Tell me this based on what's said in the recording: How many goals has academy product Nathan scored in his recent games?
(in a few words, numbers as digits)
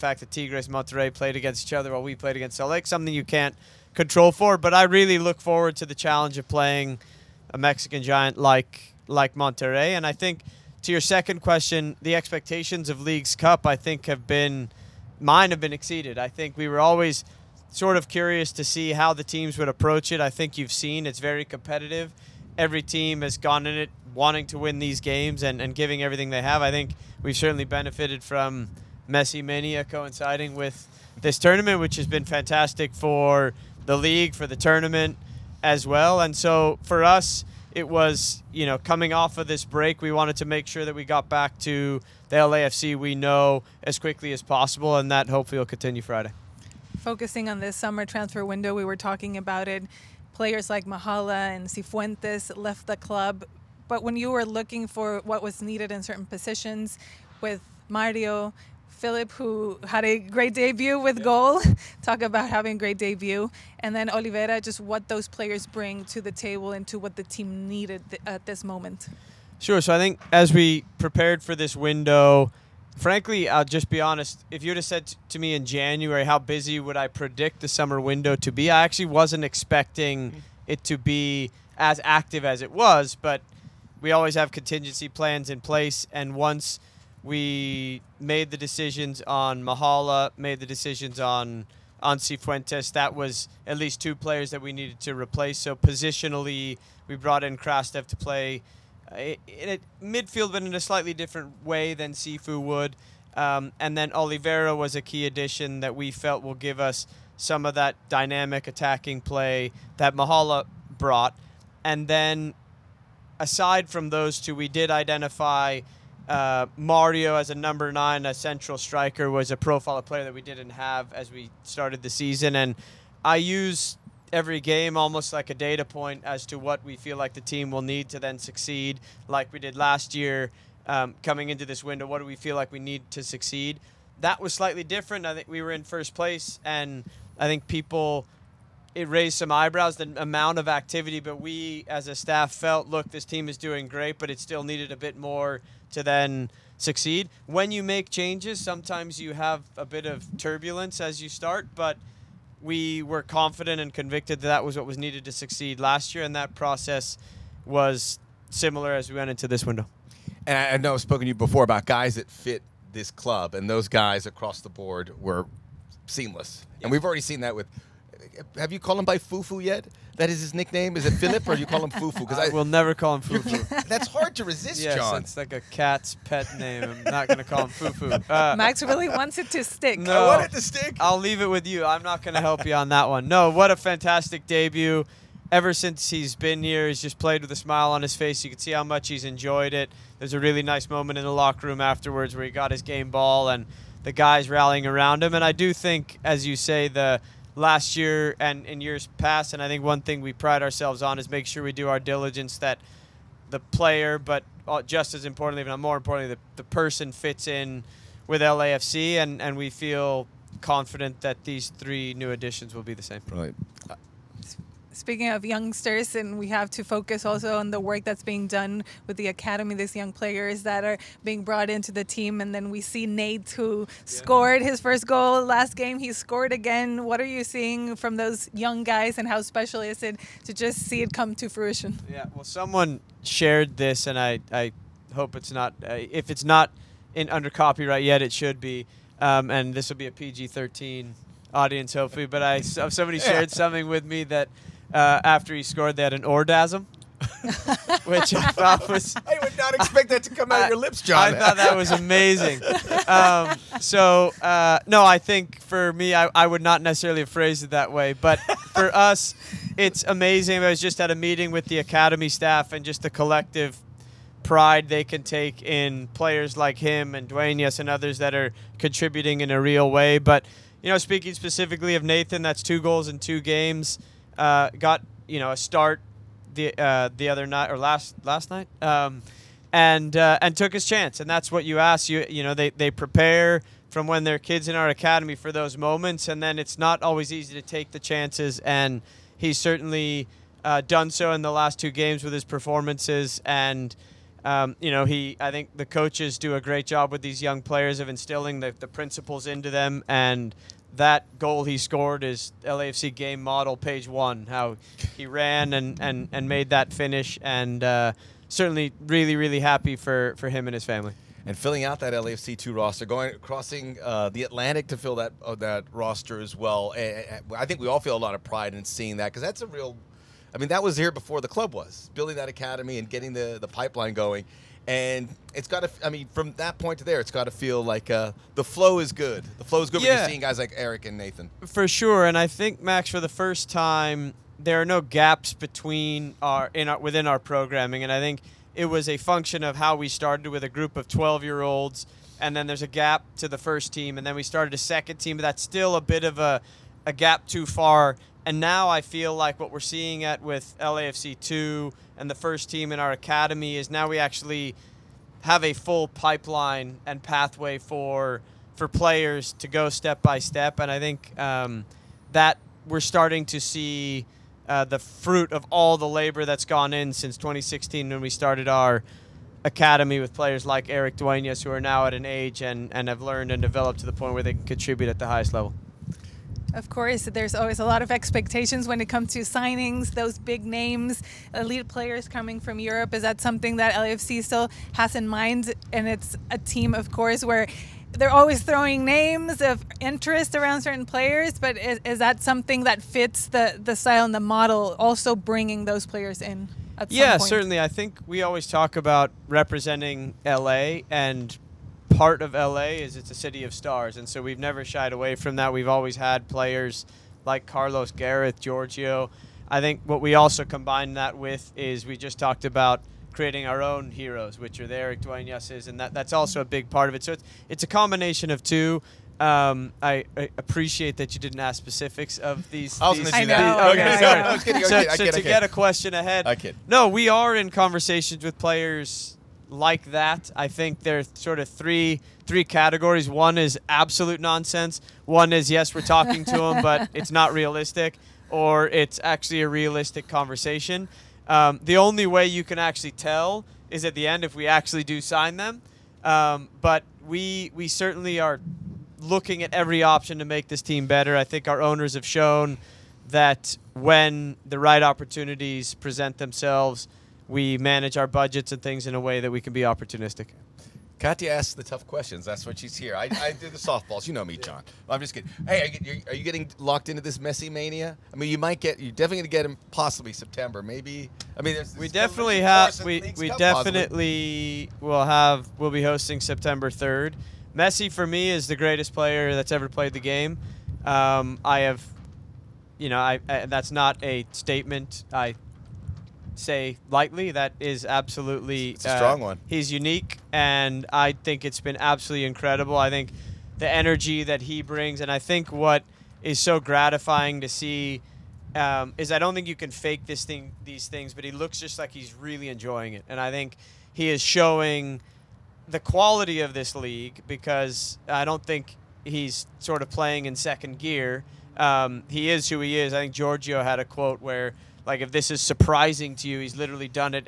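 two goals in two games.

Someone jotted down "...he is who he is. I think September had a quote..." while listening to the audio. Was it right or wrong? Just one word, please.
wrong.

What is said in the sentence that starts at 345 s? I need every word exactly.
But that's still a bit of a a gap too far.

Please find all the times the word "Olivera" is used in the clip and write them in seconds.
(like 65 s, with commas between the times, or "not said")
64 s, 104 s.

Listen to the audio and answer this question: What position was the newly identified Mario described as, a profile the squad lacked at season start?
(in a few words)
number nine.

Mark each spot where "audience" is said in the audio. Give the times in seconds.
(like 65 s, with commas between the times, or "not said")
241 s.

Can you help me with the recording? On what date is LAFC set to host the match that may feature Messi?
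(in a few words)
September 3rd.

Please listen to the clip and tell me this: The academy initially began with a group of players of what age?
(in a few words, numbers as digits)
12-year-olds.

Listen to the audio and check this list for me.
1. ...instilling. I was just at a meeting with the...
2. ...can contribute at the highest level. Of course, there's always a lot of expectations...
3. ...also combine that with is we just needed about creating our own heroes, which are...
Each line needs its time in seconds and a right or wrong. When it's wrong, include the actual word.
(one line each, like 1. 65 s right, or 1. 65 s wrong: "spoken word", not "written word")
1. 260 s wrong: "amazing", not "instilling"
2. 374 s right
3. 410 s wrong: "talked", not "needed".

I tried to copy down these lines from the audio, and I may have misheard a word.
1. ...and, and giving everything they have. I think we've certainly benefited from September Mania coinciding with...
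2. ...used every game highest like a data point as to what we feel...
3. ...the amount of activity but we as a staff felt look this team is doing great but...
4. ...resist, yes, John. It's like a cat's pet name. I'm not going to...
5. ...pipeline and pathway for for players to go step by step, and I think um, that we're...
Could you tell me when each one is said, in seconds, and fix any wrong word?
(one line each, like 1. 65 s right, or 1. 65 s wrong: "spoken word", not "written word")
1. 25 s wrong: "Messi", not "September"
2. 123 s wrong: "almost", not "highest"
3. 139 s right
4. 174 s right
5. 356 s right.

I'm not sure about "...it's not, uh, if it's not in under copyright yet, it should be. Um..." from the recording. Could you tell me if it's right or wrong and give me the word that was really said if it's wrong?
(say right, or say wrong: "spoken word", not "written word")
right.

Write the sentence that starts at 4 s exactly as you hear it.
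But I really look forward to the challenge of playing a Mexican giant like like Monterrey.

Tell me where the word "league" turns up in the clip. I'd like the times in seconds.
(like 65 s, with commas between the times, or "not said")
13 s, 33 s, 506 s.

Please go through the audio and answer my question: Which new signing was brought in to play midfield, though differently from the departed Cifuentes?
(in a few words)
Krastev.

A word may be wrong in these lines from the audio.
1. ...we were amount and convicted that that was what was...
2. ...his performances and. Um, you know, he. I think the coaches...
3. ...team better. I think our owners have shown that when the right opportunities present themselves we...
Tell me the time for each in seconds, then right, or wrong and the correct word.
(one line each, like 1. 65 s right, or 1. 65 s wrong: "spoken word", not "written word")
1. 152 s wrong: "confident", not "amount"
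2. 292 s right
3. 450 s right.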